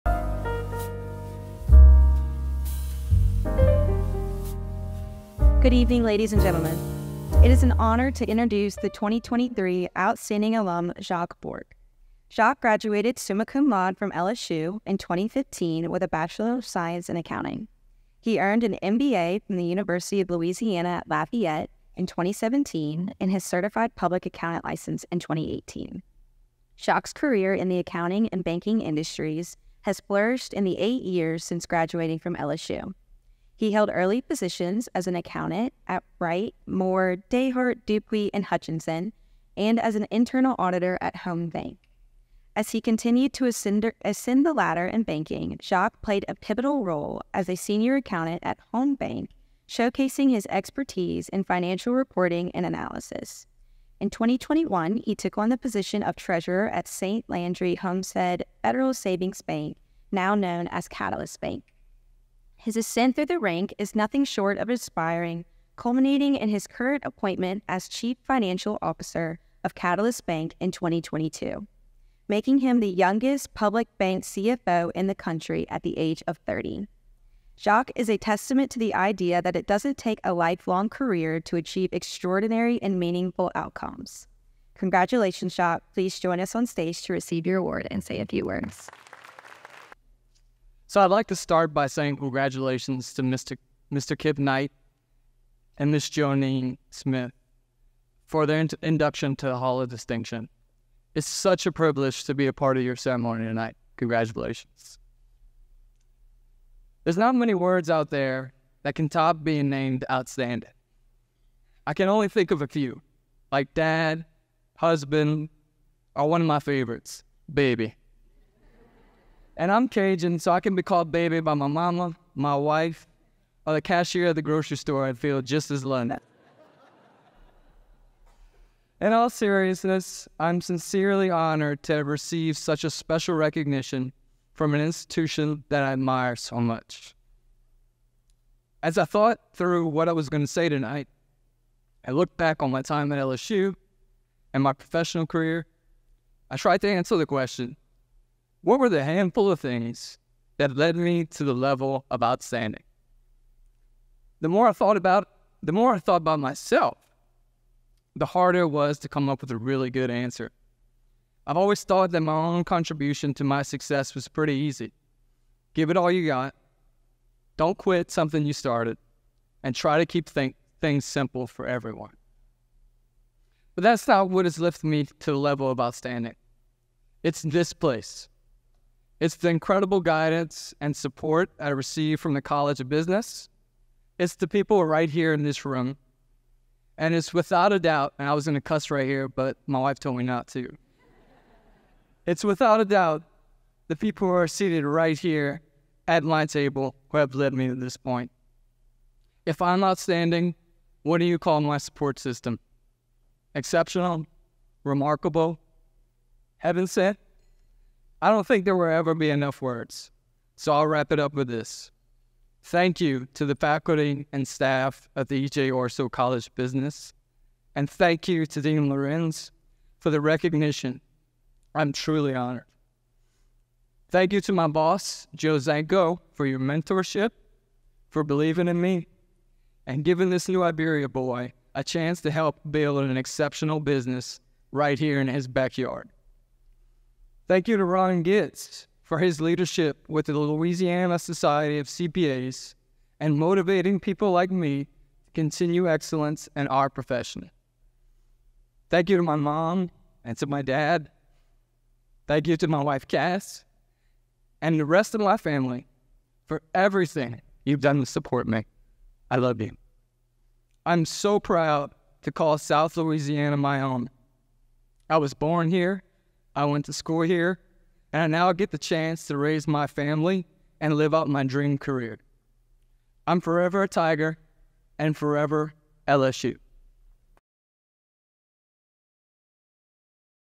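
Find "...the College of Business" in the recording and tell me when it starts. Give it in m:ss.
3:02.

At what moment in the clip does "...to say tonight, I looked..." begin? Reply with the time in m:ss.
2:20.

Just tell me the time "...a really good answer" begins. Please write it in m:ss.
2:39.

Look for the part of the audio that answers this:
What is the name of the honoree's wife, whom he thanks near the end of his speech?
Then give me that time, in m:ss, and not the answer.
4:13.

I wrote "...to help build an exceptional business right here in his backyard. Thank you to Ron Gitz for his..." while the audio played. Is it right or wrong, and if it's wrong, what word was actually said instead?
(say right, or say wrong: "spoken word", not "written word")
right.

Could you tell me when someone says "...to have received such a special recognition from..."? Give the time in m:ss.
2:11.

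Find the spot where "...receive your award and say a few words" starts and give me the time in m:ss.
1:27.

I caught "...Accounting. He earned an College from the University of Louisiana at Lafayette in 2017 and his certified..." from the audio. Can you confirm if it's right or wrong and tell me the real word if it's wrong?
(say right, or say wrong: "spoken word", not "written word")
wrong: "MBA", not "College".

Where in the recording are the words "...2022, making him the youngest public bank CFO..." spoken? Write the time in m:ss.
1:10.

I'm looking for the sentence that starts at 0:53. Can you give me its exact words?
In 2021, he took on the position of treasurer at St.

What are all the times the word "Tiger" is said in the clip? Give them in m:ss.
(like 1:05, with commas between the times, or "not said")
4:33.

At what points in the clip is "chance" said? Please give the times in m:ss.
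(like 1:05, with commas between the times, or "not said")
3:51, 4:28.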